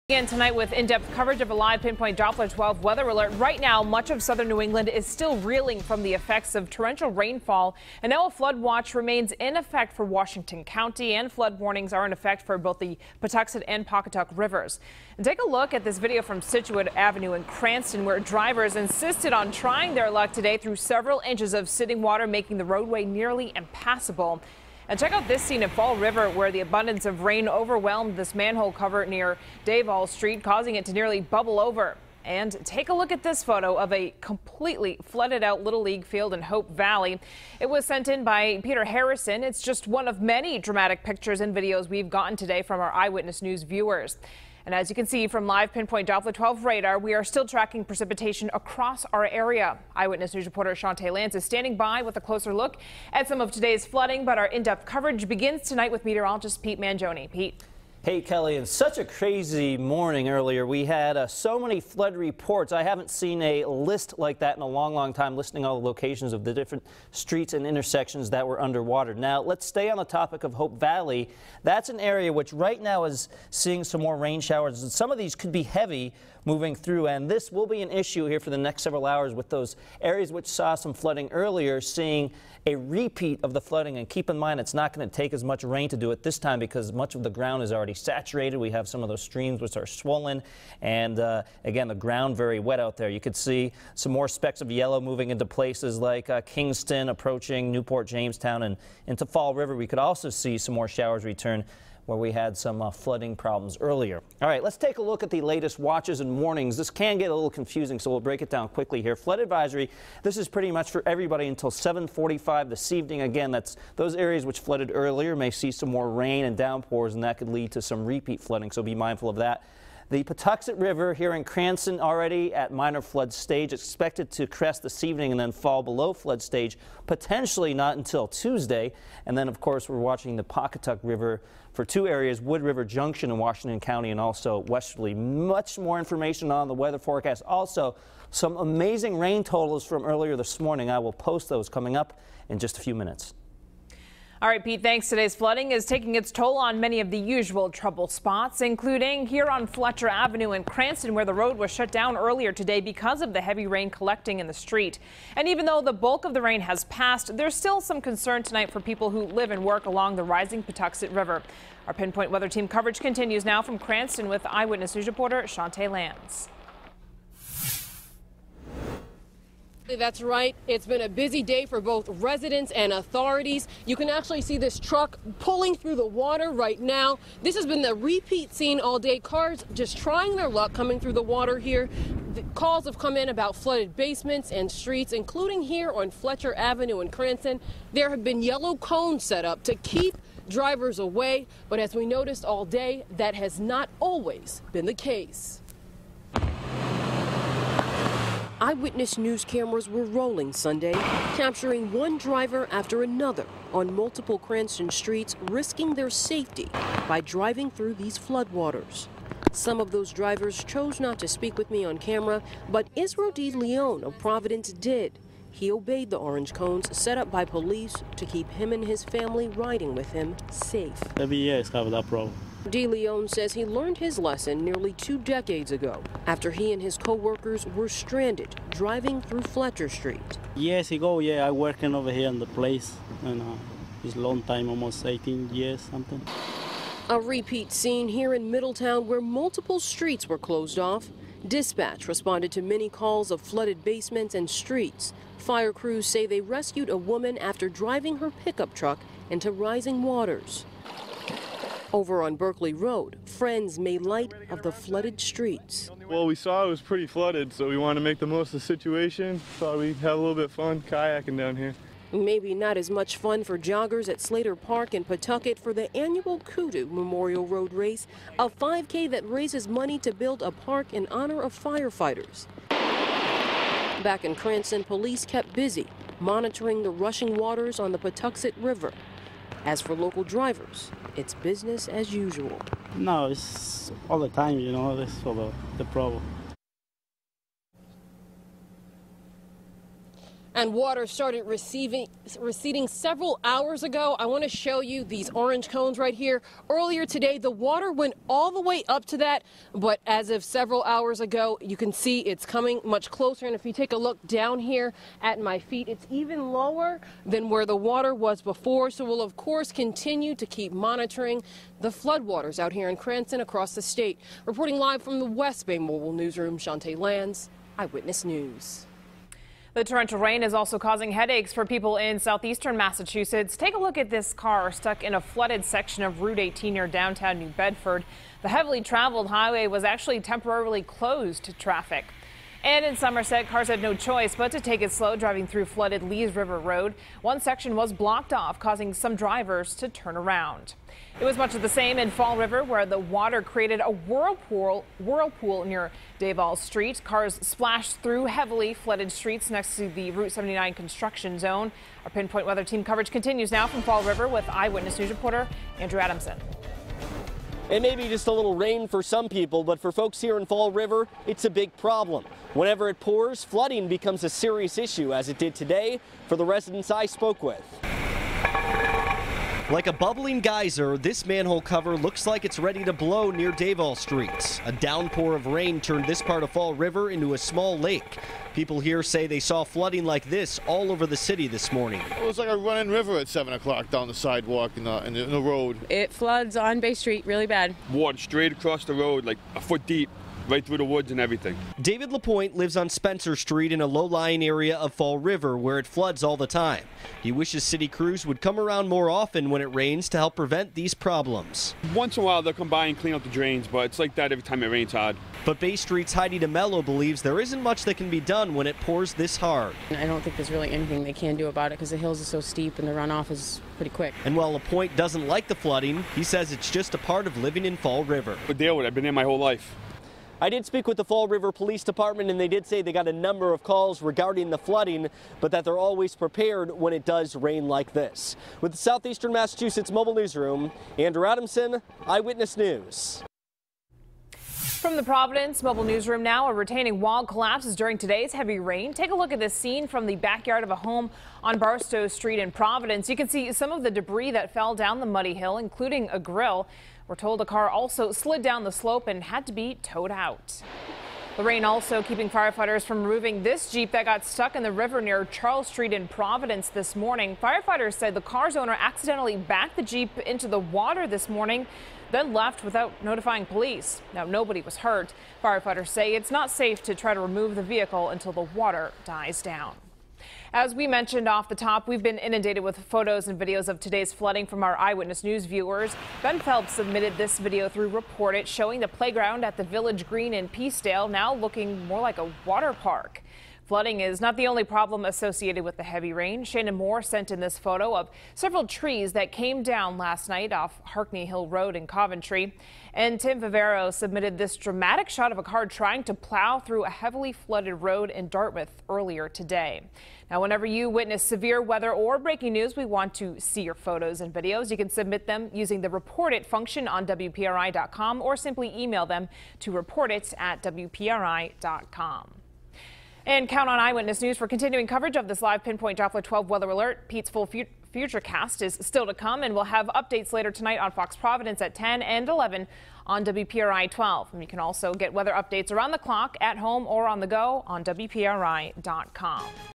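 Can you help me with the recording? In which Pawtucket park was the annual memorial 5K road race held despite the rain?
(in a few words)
Slater Park.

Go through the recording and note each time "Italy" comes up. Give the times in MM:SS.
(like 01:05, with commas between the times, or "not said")
not said.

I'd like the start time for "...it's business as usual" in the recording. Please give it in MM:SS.
04:41.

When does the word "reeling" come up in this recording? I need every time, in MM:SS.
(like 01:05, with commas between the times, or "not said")
00:05.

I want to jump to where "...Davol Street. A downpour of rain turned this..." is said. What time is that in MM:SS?
06:13.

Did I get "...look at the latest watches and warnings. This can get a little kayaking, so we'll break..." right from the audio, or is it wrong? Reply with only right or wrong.
wrong.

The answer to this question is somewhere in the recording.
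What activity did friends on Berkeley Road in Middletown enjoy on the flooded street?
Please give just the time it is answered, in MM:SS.
04:20.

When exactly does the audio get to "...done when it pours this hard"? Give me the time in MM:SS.
06:48.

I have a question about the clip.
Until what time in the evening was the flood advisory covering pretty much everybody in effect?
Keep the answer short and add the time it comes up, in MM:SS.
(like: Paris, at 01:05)
7:45, at 01:51.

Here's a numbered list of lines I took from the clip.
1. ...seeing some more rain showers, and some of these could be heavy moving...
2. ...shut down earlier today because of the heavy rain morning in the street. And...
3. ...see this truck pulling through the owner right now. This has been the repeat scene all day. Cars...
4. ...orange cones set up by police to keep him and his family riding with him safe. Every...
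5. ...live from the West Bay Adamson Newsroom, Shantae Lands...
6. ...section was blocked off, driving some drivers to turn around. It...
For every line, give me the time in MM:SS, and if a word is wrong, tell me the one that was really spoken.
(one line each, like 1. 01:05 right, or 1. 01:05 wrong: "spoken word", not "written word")
1. 01:13 right
2. 02:31 wrong: "collecting", not "morning"
3. 02:54 wrong: "water", not "owner"
4. 03:36 right
5. 05:14 wrong: "Mobile", not "Adamson"
6. 05:37 wrong: "causing", not "driving".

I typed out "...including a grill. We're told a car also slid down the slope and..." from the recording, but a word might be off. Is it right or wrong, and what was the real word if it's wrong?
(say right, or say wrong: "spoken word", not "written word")
right.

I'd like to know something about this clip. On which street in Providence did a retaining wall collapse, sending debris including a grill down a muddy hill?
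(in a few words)
Barstow Street.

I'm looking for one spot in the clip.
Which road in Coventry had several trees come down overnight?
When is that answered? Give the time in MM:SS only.
08:10.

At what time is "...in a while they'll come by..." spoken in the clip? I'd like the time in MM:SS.
06:42.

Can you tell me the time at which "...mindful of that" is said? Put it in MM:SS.
01:58.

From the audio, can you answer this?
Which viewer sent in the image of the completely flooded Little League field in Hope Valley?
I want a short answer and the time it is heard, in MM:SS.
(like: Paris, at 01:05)
Peter Harrison, at 00:38.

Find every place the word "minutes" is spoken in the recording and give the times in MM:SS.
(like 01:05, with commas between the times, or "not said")
02:22.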